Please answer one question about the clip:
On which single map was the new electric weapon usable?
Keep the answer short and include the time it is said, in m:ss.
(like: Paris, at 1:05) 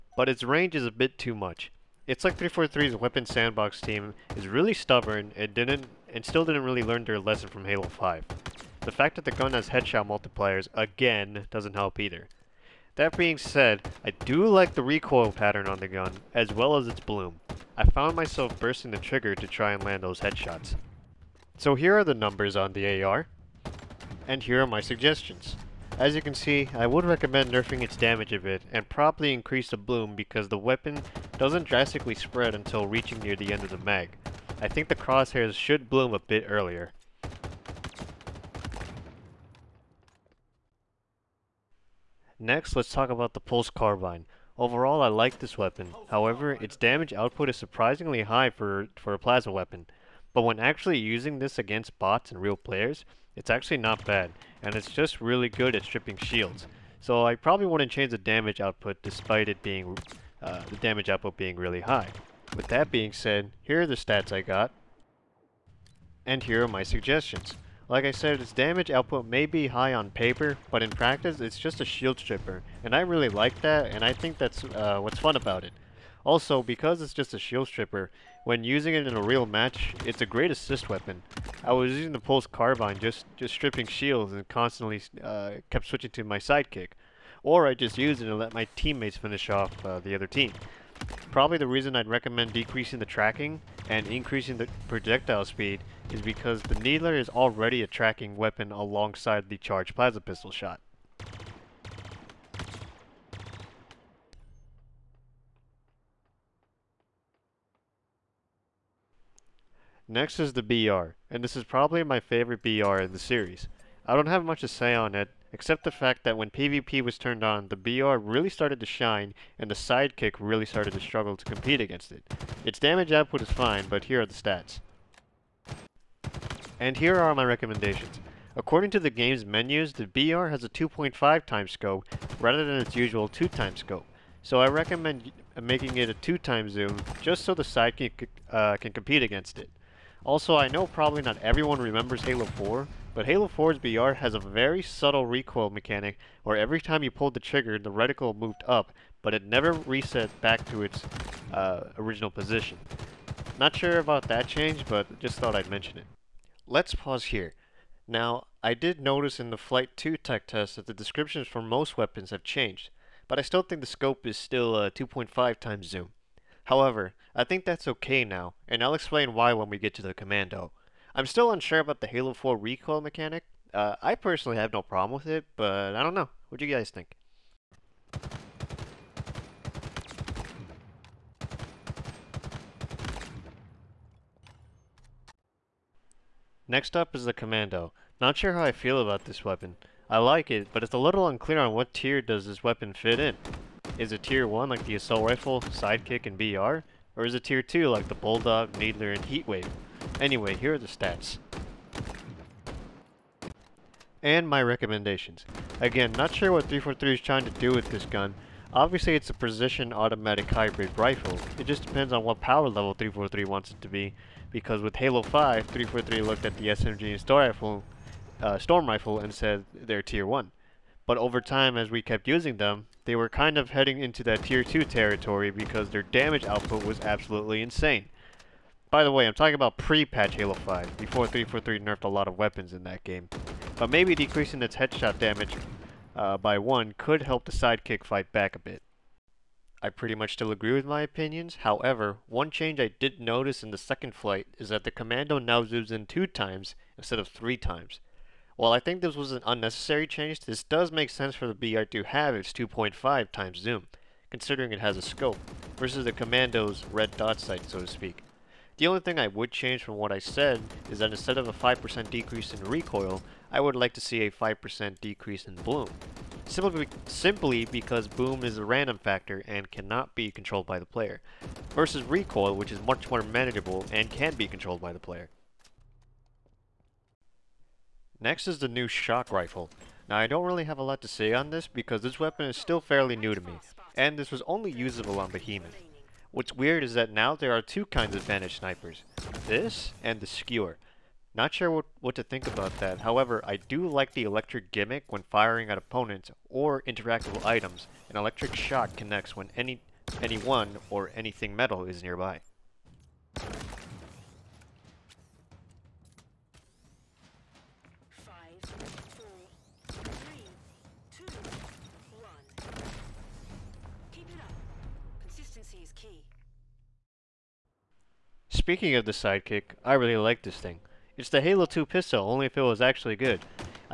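Behemoth, at 4:45.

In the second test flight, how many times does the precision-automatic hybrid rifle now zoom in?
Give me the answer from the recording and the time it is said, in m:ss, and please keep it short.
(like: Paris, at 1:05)
2 times, at 4:06.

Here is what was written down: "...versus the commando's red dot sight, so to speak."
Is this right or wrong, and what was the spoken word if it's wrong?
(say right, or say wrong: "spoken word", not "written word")
right.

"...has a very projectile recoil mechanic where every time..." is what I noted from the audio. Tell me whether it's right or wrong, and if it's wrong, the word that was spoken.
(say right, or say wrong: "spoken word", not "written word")
wrong: "subtle", not "projectile".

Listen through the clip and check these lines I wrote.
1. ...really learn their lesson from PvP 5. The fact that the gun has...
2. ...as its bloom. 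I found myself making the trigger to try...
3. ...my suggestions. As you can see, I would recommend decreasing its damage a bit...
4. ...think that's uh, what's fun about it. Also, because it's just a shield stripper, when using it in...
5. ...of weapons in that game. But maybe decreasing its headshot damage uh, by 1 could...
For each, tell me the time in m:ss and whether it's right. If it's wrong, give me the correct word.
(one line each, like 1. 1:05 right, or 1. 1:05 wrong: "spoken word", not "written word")
1. 0:06 wrong: "Halo", not "PvP"
2. 0:16 wrong: "bursting", not "making"
3. 0:24 wrong: "nerfing", not "decreasing"
4. 1:14 right
5. 3:52 right.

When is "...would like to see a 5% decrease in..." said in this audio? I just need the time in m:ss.
4:23.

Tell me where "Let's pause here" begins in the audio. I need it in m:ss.
2:36.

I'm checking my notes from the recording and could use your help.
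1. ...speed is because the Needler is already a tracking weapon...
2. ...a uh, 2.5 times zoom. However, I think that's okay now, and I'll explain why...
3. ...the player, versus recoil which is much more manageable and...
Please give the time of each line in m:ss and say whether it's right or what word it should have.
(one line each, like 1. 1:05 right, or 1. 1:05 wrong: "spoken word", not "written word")
1. 1:35 right
2. 2:44 right
3. 4:30 right.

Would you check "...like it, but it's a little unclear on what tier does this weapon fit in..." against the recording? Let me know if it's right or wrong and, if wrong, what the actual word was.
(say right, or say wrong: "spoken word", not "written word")
right.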